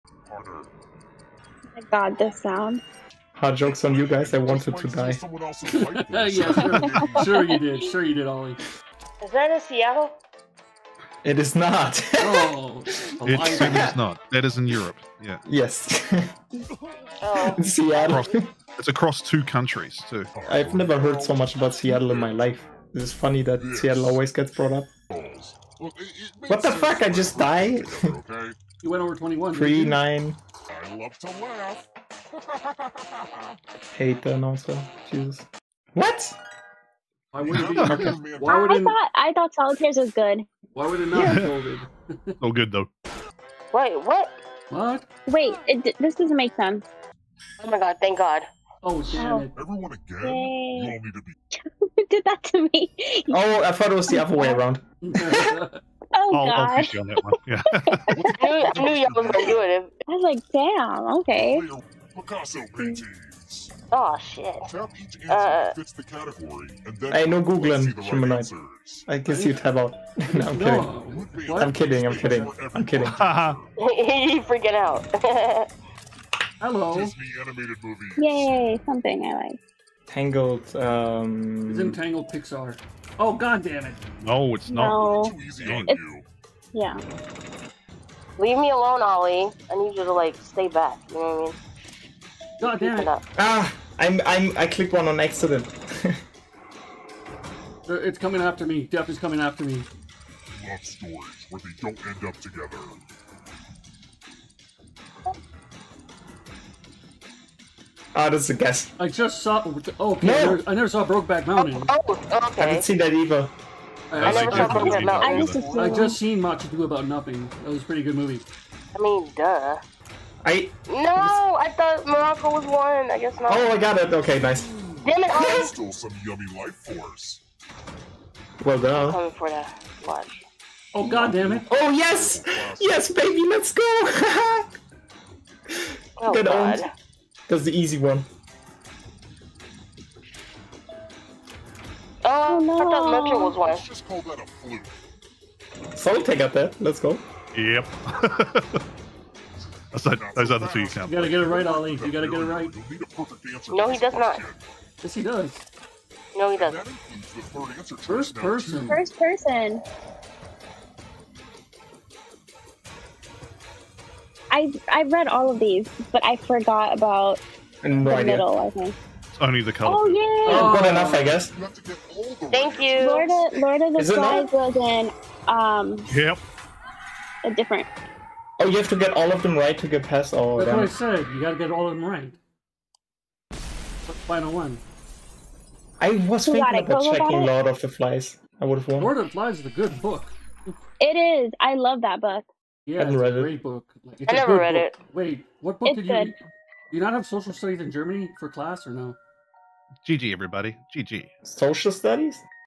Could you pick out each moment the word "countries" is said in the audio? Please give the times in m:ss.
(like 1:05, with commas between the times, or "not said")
0:19.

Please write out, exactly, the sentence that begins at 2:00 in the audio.
I no, I thought Morocco was one.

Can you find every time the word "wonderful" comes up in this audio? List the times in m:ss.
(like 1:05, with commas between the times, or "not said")
not said.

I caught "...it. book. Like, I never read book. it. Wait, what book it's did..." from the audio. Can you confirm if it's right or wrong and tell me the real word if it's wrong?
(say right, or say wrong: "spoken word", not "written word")
right.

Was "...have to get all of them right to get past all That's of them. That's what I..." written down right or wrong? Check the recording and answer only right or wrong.
right.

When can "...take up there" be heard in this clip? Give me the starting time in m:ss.
2:26.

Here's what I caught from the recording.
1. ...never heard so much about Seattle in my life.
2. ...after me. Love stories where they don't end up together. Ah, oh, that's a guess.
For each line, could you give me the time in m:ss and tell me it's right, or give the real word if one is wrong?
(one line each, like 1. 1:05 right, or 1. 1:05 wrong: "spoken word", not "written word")
1. 0:20 right
2. 1:39 right.